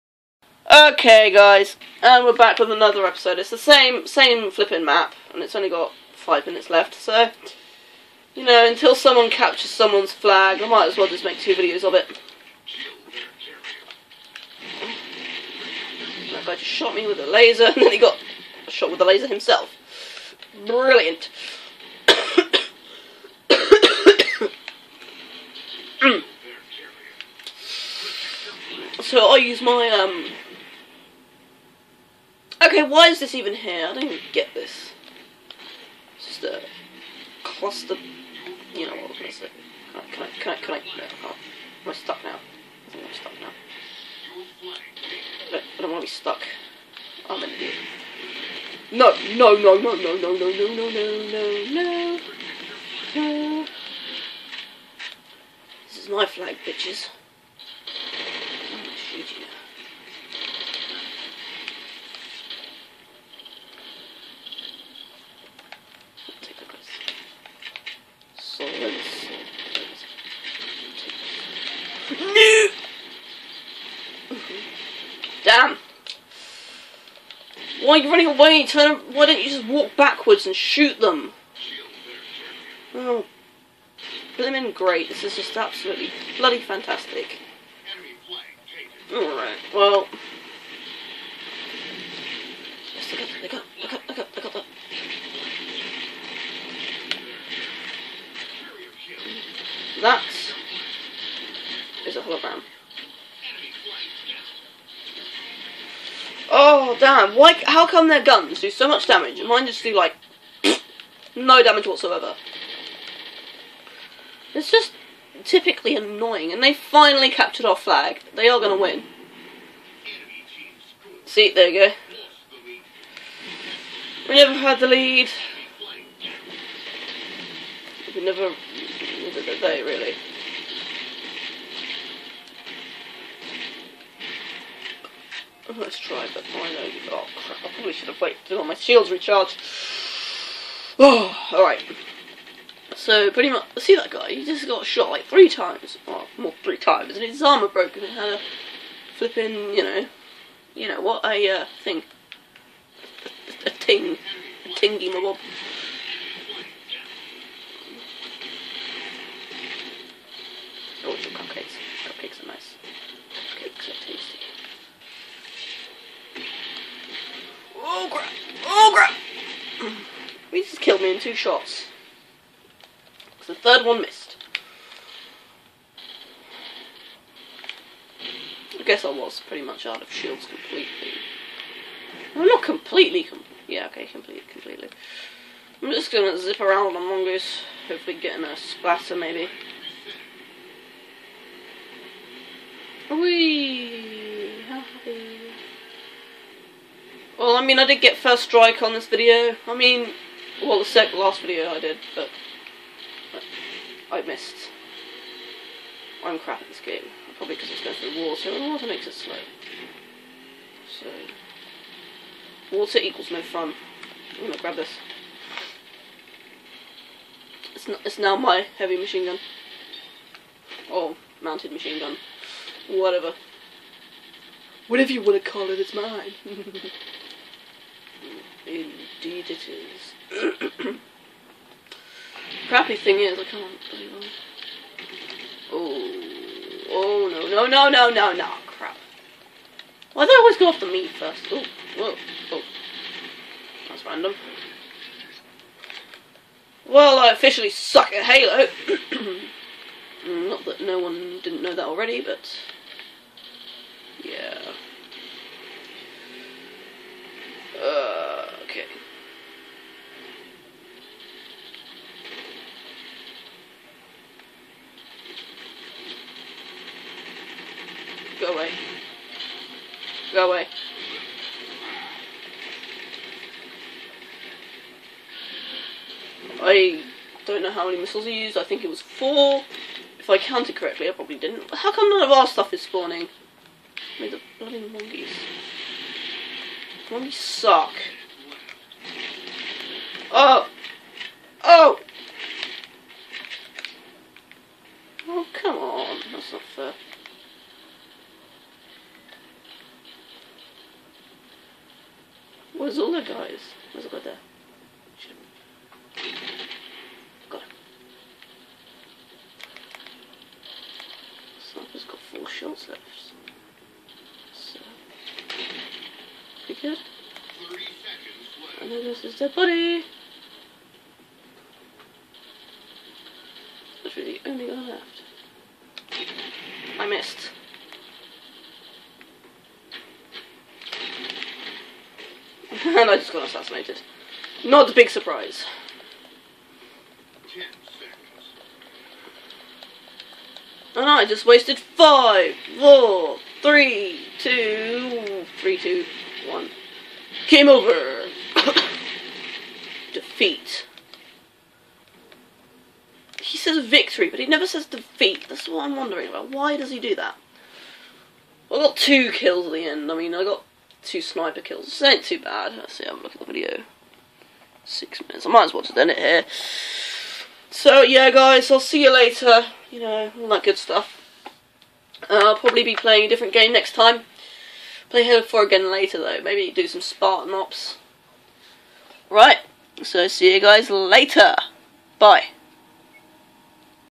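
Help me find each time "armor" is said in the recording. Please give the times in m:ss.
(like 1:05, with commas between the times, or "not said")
2:27.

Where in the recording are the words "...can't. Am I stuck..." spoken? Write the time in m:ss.
0:41.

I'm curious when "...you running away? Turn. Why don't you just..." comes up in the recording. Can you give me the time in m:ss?
1:17.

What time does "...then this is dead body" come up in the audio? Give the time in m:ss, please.
5:18.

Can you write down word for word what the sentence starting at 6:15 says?
Play Halo 4 again later, though.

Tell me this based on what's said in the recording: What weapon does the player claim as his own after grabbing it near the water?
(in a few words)
heavy machine gun.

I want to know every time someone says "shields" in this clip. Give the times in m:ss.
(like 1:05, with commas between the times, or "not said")
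2:18, 3:00.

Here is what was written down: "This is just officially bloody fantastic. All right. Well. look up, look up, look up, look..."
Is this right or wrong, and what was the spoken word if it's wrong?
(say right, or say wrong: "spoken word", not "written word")
wrong: "absolutely", not "officially".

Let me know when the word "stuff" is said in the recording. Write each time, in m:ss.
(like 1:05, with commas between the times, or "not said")
4:42, 6:10.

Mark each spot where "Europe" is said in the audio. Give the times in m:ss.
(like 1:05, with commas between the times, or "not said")
not said.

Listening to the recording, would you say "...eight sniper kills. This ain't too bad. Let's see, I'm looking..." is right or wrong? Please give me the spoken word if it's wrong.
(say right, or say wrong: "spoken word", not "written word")
wrong: "two", not "eight".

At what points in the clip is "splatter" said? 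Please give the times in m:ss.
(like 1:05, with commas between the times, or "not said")
3:08.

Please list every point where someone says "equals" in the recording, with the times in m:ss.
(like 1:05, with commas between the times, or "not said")
3:32.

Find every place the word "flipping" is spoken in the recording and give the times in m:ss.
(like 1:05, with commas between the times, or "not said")
0:04, 2:29.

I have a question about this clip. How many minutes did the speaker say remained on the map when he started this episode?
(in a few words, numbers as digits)
5.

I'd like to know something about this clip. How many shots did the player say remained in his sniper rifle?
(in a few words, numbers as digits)
4.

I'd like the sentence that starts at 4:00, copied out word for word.
Why do I always go off the meat first?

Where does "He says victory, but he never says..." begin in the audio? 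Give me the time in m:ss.
5:53.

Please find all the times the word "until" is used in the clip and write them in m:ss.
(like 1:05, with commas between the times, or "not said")
0:08, 2:18.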